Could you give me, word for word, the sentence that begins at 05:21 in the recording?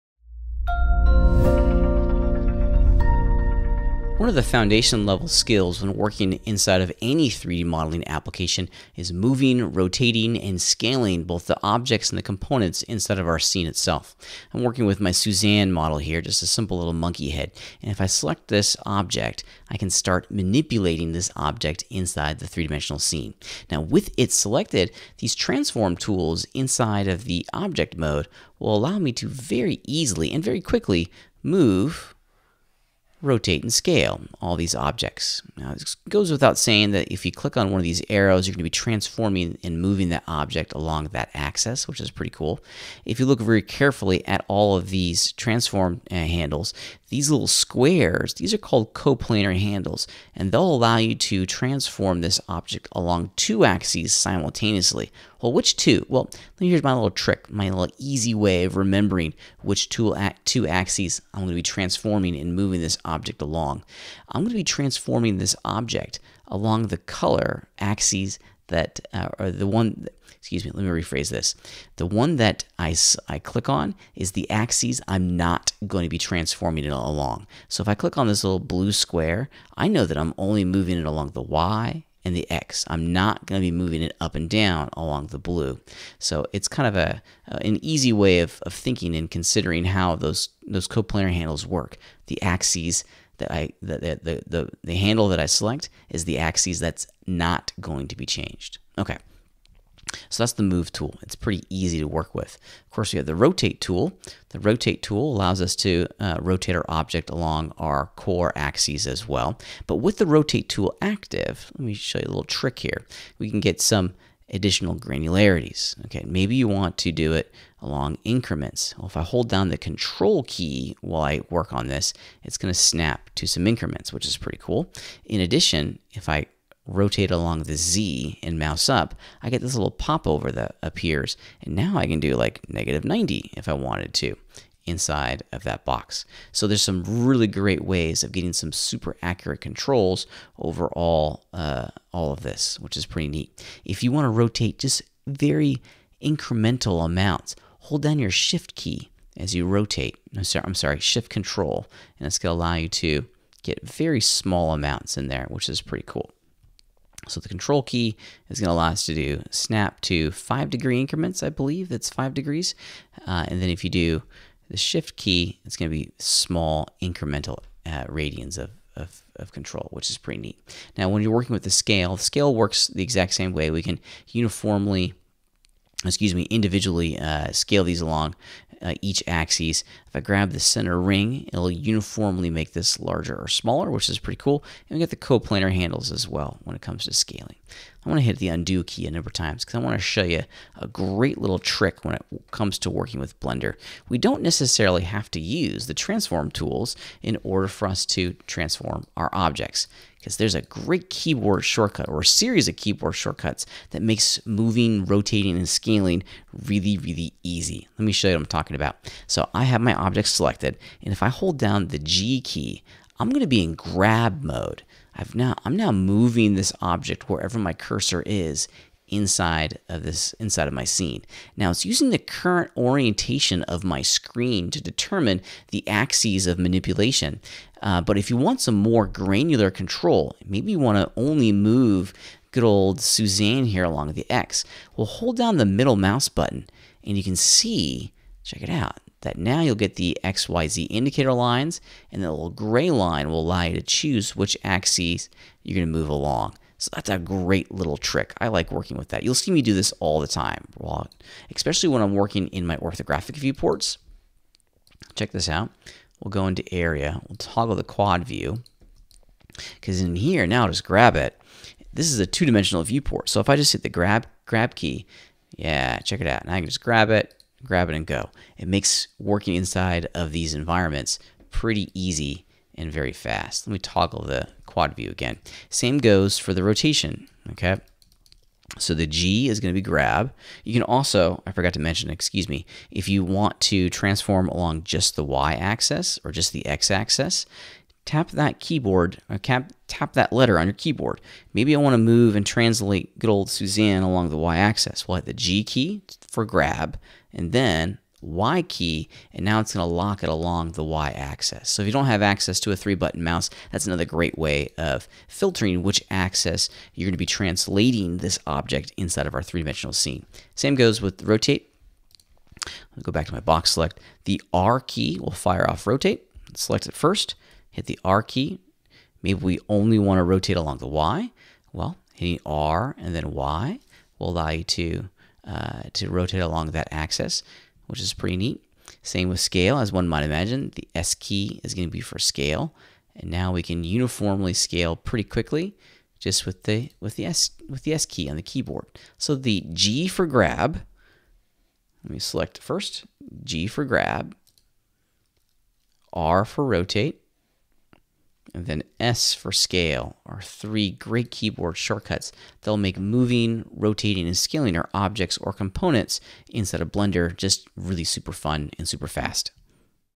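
Well, hitting R and then Y will allow you to, uh, to rotate along that axis, which is pretty neat.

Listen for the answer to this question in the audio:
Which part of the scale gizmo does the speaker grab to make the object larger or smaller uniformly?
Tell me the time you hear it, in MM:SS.
03:00.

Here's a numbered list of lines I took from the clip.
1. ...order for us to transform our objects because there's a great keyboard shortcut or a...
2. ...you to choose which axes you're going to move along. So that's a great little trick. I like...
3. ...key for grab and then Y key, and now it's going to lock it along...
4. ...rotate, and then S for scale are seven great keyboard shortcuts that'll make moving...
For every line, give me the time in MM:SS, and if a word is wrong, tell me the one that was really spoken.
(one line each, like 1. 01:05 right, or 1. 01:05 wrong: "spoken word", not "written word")
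1. 03:17 right
2. 04:03 right
3. 04:55 right
4. 05:46 wrong: "three", not "seven".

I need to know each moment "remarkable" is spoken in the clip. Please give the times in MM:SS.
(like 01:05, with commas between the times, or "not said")
not said.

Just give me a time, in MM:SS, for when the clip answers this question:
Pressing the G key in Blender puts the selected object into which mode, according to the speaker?
03:33.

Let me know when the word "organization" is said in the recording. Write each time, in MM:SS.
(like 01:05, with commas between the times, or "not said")
not said.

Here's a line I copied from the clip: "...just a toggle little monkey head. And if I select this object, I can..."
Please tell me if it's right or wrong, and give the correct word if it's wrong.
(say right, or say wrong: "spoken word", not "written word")
wrong: "simple", not "toggle".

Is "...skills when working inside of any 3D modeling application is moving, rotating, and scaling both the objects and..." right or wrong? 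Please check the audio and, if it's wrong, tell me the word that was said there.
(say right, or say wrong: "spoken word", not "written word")
right.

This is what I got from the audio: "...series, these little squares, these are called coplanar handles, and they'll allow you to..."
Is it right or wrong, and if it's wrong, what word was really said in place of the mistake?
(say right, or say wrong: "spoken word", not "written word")
wrong: "handles", not "series".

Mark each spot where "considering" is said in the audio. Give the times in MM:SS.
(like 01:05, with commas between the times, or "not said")
01:29.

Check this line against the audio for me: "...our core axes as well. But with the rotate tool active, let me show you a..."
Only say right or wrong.
right.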